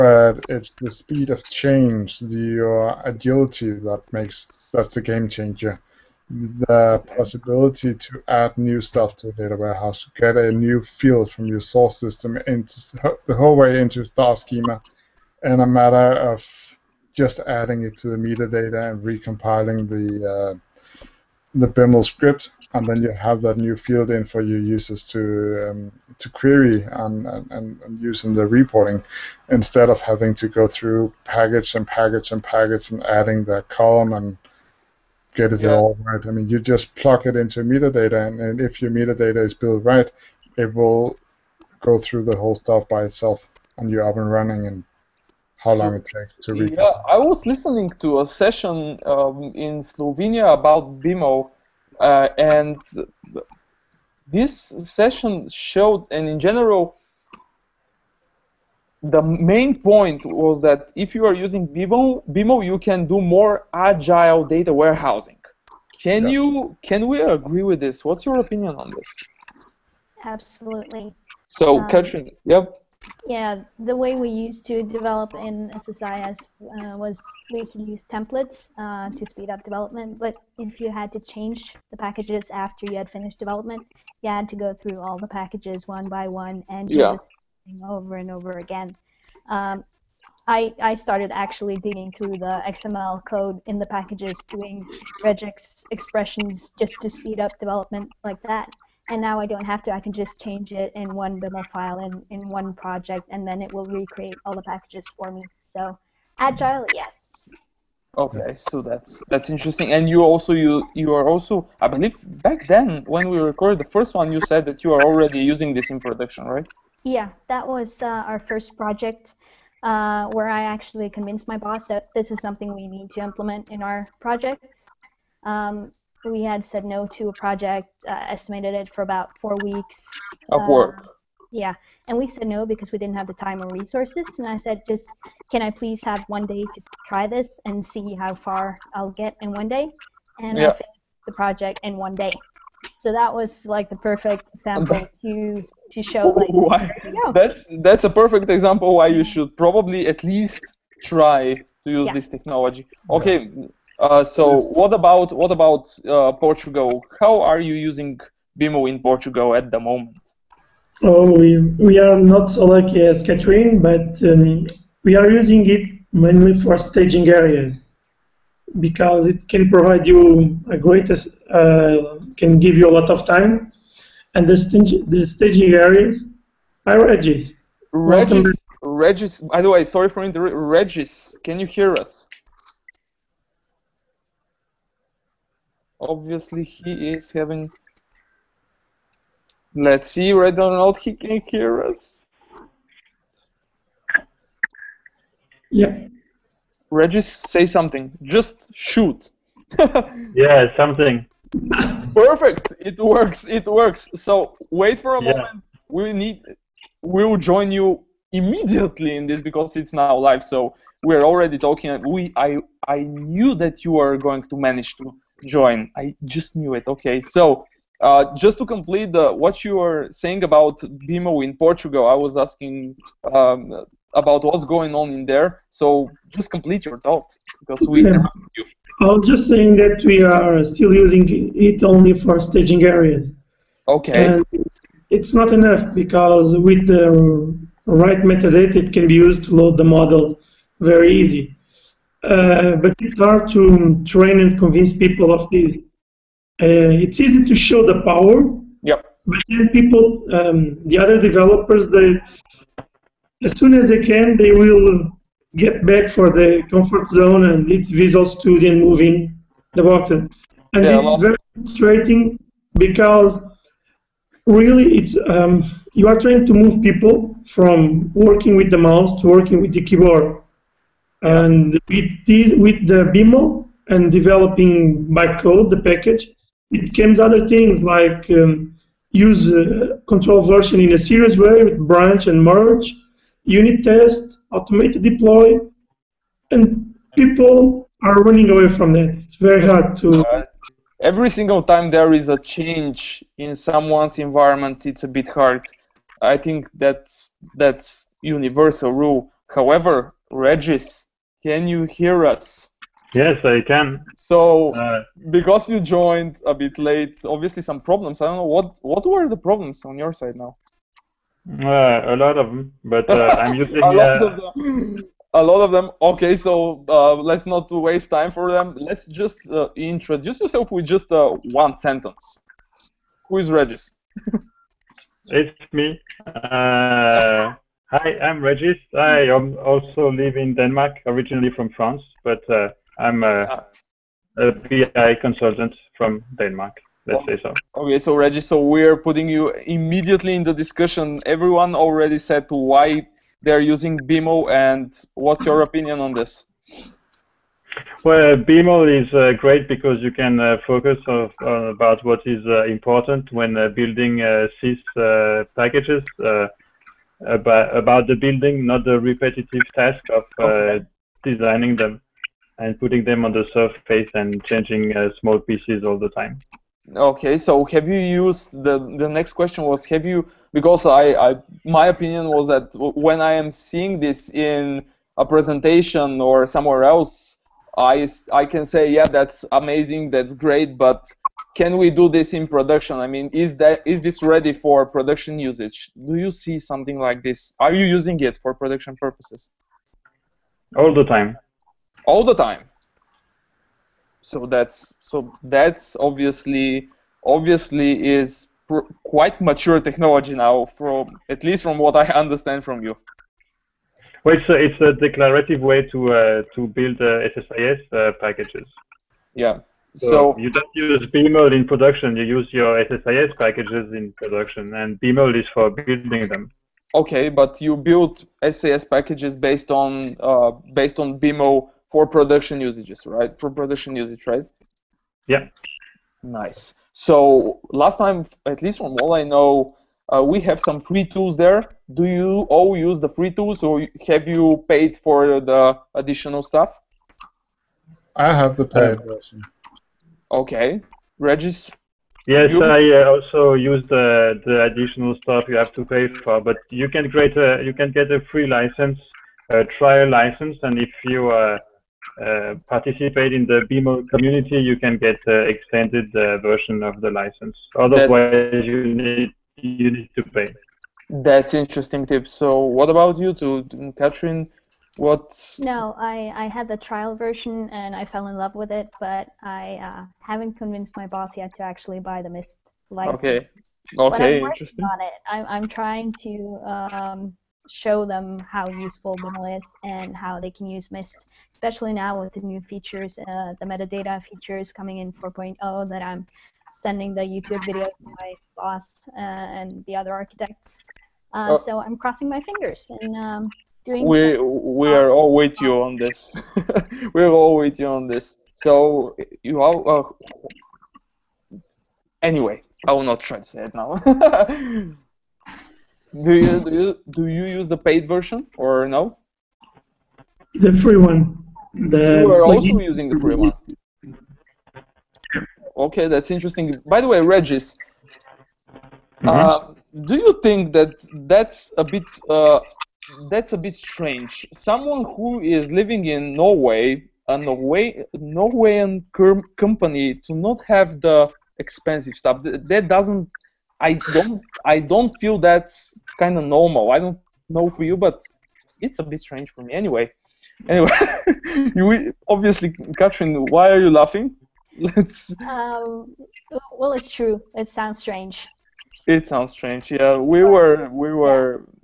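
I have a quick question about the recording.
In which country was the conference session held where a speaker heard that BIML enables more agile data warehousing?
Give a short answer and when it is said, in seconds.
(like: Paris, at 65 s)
Slovenia, at 49 s.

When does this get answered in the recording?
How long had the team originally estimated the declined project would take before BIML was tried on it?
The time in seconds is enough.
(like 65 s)
129 s.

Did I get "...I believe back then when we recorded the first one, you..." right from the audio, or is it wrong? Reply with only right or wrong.
right.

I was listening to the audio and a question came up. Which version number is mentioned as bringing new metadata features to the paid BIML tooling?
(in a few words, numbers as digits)
4.0.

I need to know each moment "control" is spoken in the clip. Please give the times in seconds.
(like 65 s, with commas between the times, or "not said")
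280 s.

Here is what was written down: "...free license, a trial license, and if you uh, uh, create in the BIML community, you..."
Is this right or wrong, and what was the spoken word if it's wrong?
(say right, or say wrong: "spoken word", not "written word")
wrong: "participate", not "create".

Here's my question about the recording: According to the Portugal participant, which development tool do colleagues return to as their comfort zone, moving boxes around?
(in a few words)
Visual Studio.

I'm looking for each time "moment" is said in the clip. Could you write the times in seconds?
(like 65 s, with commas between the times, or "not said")
159 s, 205 s.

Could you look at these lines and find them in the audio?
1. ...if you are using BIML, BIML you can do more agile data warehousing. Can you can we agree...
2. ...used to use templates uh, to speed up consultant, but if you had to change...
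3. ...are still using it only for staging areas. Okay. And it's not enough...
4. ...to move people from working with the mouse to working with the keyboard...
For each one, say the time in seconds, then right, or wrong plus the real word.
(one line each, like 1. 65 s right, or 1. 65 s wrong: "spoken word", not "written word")
1. 60 s right
2. 77 s wrong: "development", not "consultant"
3. 230 s right
4. 266 s right.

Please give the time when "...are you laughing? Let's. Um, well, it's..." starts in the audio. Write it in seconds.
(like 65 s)
543 s.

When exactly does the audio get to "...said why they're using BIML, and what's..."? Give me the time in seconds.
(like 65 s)
342 s.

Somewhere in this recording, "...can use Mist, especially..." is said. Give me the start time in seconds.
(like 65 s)
480 s.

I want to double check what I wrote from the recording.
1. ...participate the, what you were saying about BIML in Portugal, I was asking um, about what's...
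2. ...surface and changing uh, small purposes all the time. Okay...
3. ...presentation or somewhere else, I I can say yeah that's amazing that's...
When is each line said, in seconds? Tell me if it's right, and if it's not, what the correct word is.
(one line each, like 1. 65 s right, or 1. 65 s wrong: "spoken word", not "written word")
1. 218 s wrong: "complete", not "participate"
2. 363 s wrong: "pieces", not "purposes"
3. 375 s right.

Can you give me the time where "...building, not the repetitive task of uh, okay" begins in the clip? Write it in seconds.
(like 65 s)
358 s.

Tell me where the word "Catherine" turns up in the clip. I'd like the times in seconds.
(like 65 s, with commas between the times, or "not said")
463 s, 542 s.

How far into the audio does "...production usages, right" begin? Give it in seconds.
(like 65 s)
422 s.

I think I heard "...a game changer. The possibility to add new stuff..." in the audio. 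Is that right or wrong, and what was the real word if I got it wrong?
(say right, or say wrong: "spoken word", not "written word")
right.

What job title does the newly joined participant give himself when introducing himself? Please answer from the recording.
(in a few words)
BI consultant.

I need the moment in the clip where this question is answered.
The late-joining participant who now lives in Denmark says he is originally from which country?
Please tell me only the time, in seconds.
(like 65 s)
331 s.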